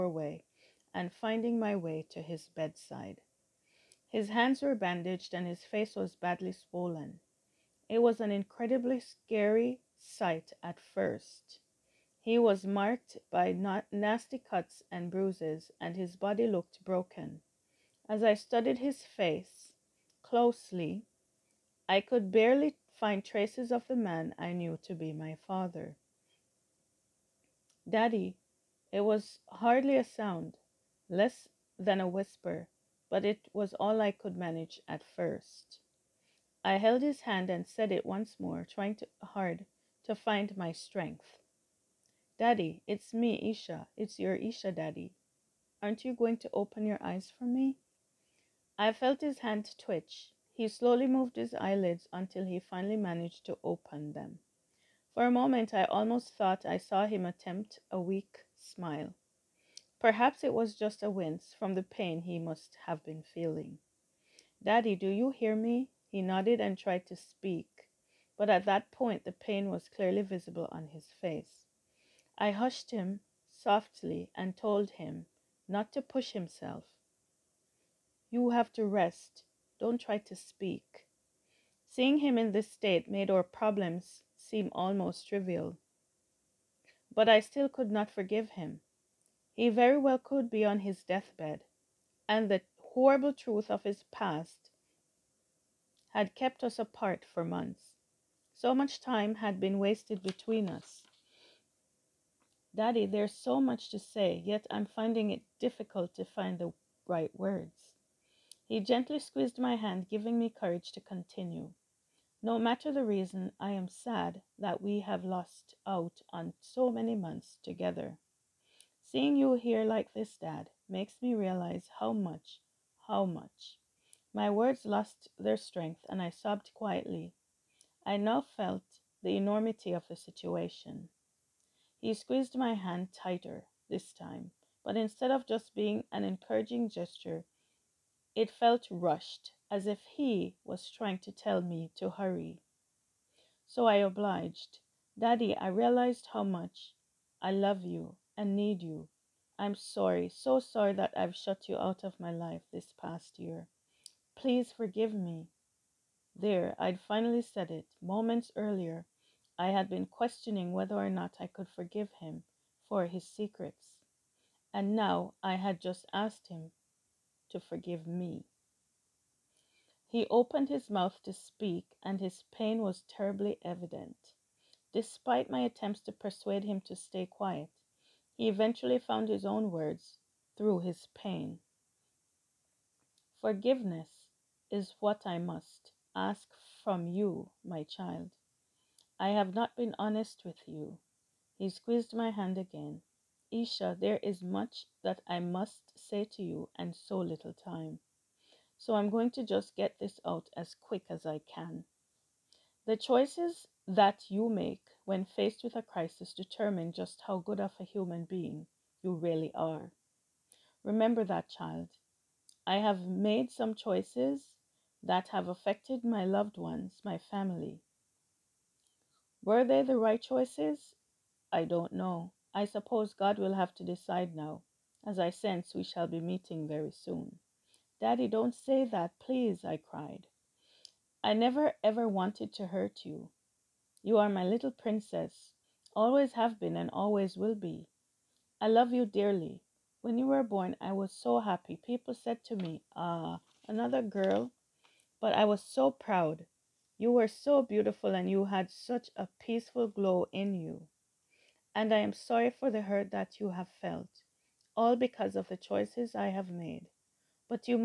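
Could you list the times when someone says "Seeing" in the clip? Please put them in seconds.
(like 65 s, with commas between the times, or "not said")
81 s, 119 s.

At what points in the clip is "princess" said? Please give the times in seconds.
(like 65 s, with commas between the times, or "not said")
234 s.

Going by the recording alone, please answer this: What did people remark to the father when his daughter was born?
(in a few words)
another girl.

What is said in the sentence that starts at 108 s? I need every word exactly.
He gently squeezed my hand, giving me courage to continue.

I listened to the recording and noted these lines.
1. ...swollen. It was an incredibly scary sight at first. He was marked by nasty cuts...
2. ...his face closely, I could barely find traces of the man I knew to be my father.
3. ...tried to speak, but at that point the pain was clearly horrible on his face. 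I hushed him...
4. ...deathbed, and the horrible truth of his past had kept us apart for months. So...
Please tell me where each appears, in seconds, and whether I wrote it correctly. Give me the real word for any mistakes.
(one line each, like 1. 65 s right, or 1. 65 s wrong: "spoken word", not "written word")
1. 6 s right
2. 18 s right
3. 66 s wrong: "visible", not "horrible"
4. 91 s right.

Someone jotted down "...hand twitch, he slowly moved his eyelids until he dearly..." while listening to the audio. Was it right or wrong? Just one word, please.
wrong.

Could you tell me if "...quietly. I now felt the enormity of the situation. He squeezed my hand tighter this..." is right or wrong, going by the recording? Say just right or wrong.
right.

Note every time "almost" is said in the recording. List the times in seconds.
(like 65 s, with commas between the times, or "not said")
55 s, 84 s.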